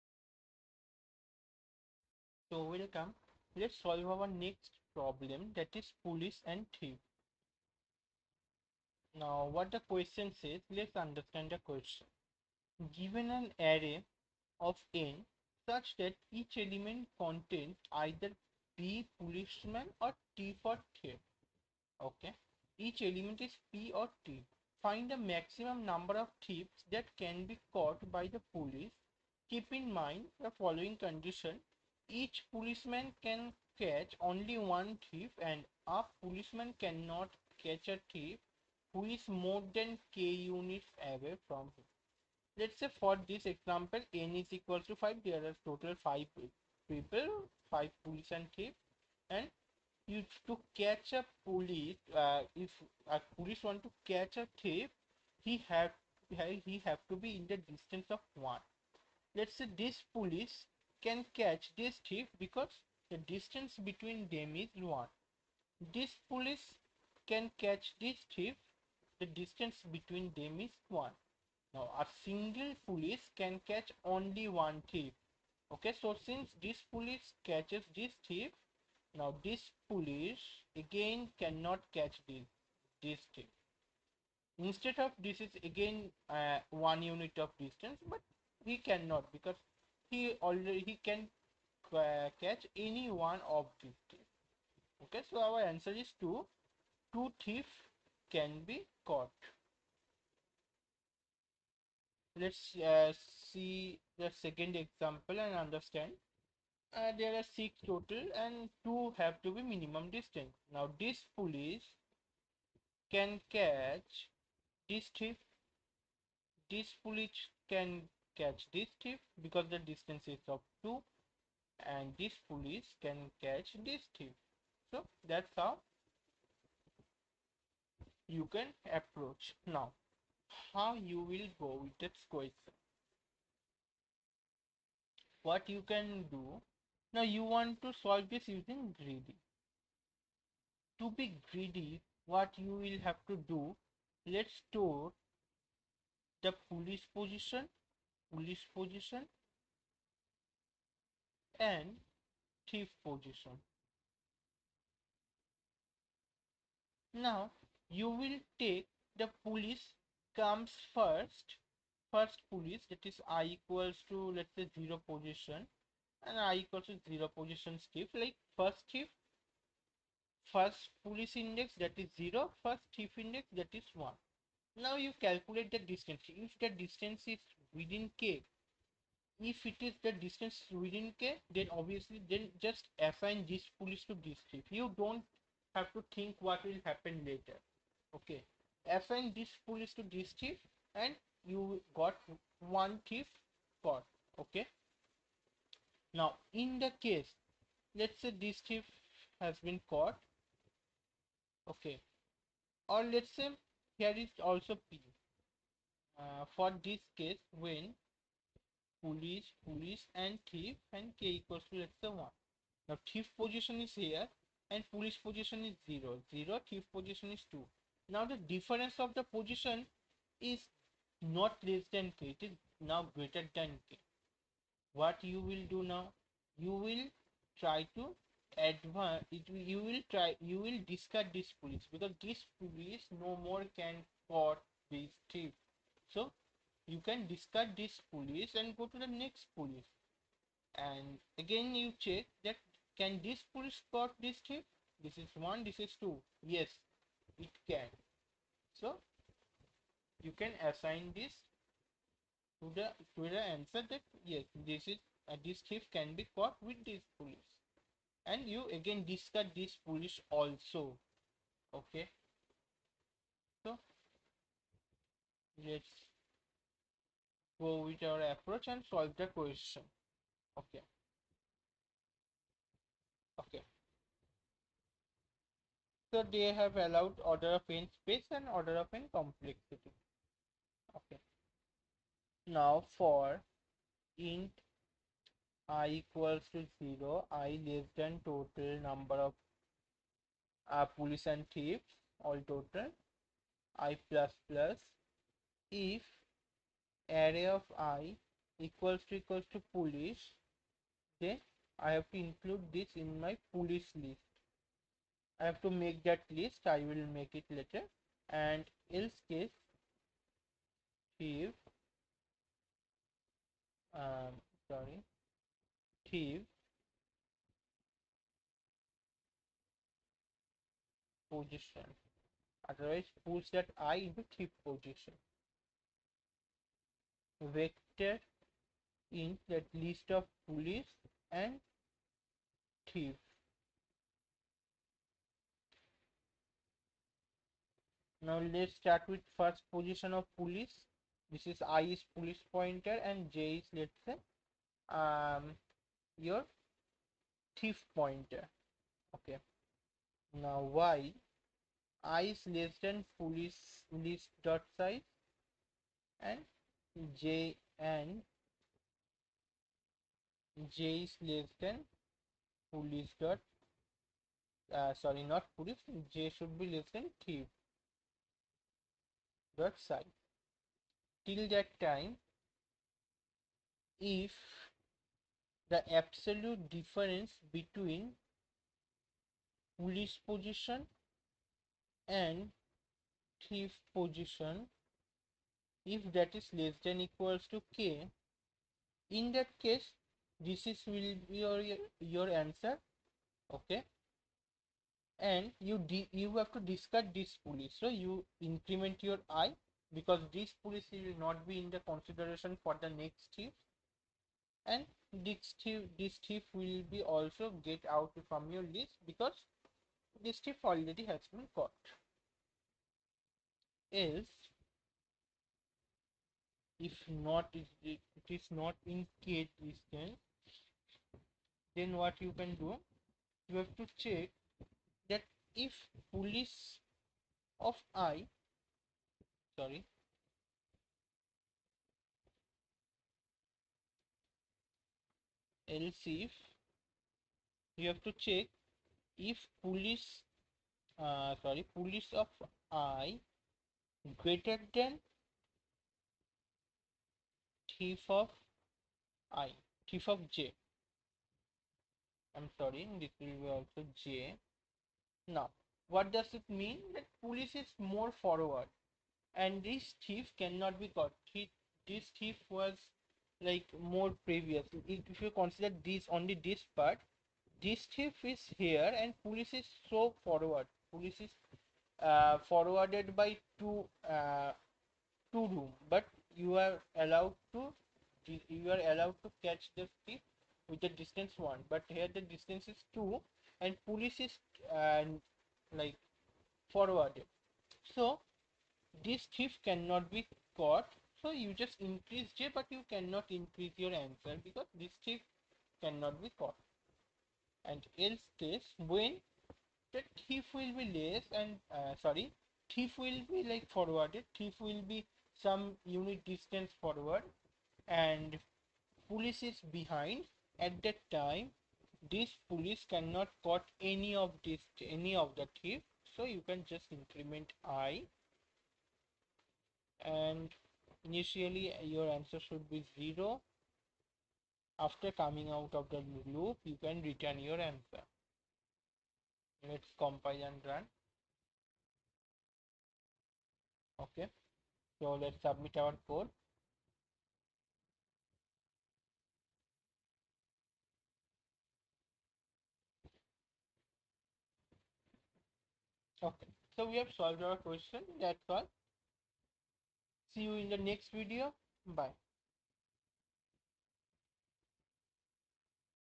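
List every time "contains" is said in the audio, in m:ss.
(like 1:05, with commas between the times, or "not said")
0:17.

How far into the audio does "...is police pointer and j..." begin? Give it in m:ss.
5:41.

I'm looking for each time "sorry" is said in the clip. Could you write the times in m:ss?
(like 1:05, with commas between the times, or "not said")
5:14, 6:04, 7:09, 7:21, 7:32, 8:22.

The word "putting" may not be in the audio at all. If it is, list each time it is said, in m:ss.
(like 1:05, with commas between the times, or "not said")
not said.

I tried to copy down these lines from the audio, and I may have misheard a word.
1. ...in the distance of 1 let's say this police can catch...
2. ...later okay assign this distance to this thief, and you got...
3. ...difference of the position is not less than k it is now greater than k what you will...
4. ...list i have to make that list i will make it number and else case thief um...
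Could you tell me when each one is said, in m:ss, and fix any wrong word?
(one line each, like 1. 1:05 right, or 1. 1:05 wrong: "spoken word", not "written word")
1. 0:57 right
2. 3:07 wrong: "police", not "distance"
3. 3:38 right
4. 5:04 wrong: "later", not "number".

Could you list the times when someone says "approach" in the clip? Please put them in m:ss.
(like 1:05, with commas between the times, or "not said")
2:08, 4:28.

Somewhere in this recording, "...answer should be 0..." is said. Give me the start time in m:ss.
8:42.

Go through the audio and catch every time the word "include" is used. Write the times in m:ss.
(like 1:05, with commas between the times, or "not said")
5:02.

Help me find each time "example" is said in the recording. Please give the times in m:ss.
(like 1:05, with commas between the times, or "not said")
0:43, 1:44.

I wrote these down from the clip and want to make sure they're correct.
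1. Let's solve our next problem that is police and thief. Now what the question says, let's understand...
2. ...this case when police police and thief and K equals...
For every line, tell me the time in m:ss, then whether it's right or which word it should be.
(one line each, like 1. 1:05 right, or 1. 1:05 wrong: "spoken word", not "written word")
1. 0:03 right
2. 3:26 right.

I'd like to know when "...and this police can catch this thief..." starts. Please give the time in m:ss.
2:01.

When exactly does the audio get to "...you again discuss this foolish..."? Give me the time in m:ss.
4:18.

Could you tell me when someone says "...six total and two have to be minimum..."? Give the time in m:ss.
1:47.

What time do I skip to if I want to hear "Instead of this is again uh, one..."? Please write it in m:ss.
1:24.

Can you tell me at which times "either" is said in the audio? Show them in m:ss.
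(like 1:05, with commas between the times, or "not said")
0:17.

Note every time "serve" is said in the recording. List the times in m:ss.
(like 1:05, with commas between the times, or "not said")
not said.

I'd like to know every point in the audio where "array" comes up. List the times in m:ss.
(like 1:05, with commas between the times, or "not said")
0:13, 4:57.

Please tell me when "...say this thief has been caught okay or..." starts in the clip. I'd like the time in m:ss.
3:18.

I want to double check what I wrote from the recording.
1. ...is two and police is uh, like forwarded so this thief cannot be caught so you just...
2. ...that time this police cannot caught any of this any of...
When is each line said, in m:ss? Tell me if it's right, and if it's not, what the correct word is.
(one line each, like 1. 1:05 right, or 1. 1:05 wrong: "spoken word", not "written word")
1. 8:02 right
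2. 8:30 right.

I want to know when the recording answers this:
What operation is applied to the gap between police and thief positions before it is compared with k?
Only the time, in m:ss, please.
6:15.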